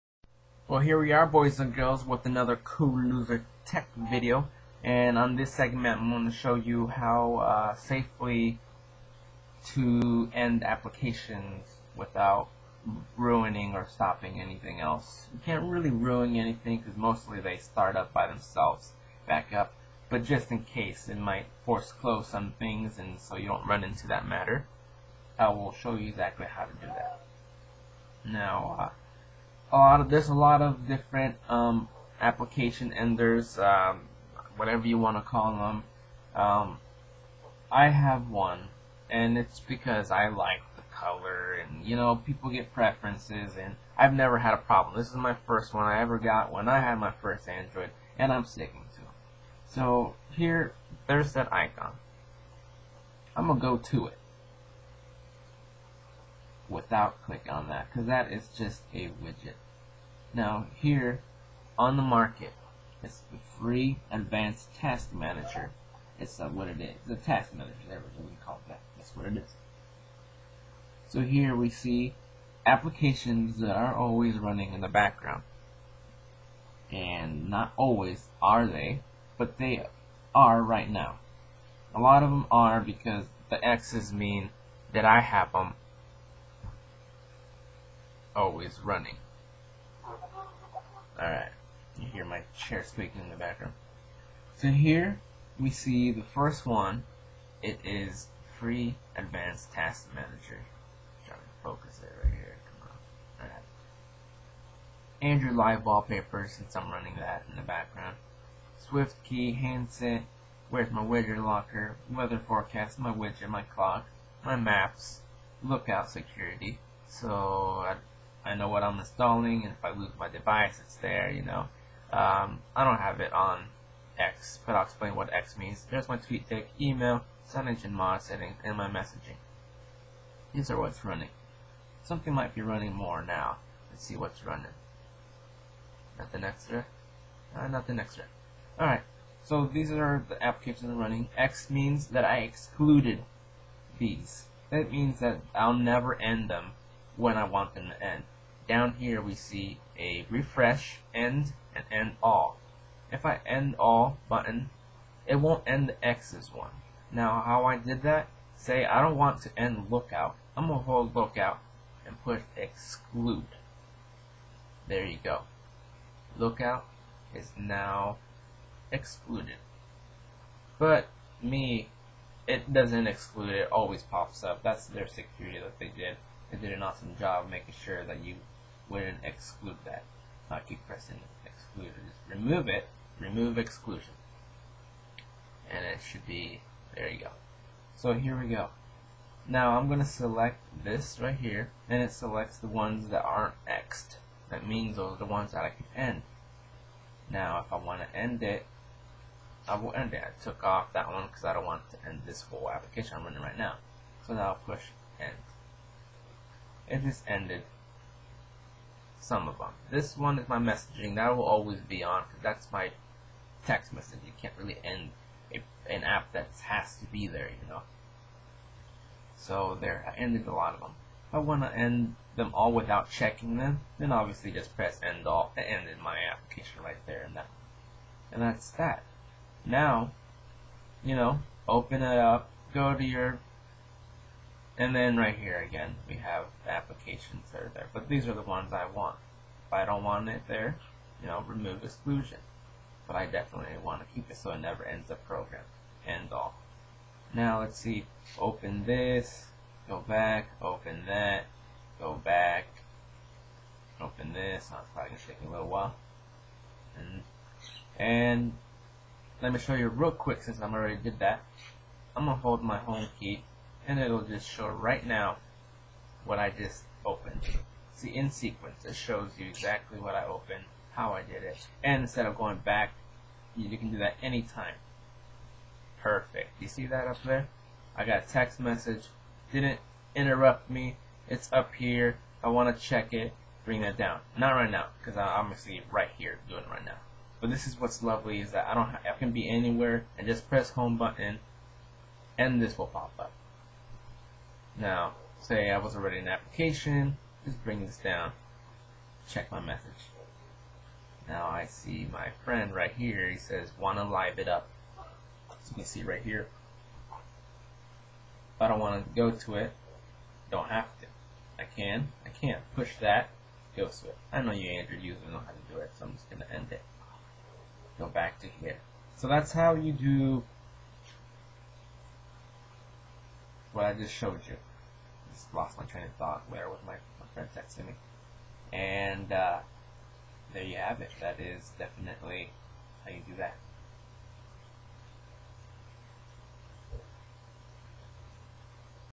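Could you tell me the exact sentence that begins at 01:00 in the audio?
Now here on the market it's the free advanced task manager.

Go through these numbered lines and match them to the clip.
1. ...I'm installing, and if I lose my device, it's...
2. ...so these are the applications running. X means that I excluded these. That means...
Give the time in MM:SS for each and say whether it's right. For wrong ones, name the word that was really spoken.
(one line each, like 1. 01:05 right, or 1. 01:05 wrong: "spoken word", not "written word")
1. 01:58 right
2. 02:19 right.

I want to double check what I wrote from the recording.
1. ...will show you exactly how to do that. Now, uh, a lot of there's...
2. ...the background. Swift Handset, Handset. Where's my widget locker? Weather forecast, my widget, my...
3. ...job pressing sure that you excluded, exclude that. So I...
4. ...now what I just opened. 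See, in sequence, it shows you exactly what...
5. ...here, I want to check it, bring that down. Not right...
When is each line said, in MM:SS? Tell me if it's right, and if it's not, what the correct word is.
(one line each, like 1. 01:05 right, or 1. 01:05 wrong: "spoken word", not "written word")
1. 00:25 right
2. 01:47 wrong: "Key", not "Handset"
3. 02:57 wrong: "making", not "pressing"
4. 04:25 right
5. 04:41 right.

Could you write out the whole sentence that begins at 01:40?
I'm trying to focus it right here.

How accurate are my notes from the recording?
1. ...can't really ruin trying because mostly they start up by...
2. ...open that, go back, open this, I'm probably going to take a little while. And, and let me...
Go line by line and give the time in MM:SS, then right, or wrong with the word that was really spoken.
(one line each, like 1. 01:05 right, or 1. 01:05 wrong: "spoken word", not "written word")
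1. 00:15 wrong: "anything", not "trying"
2. 04:10 right.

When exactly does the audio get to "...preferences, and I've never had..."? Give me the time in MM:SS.
00:42.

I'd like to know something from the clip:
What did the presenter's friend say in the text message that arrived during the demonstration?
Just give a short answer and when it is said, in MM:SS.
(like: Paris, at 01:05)
wanna live it up, at 05:03.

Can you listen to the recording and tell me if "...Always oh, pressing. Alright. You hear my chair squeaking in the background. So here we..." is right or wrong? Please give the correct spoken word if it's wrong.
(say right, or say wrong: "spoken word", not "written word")
wrong: "running", not "pressing".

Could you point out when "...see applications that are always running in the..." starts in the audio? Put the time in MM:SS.
01:11.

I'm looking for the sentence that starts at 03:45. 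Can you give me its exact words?
end ended my application right there and that.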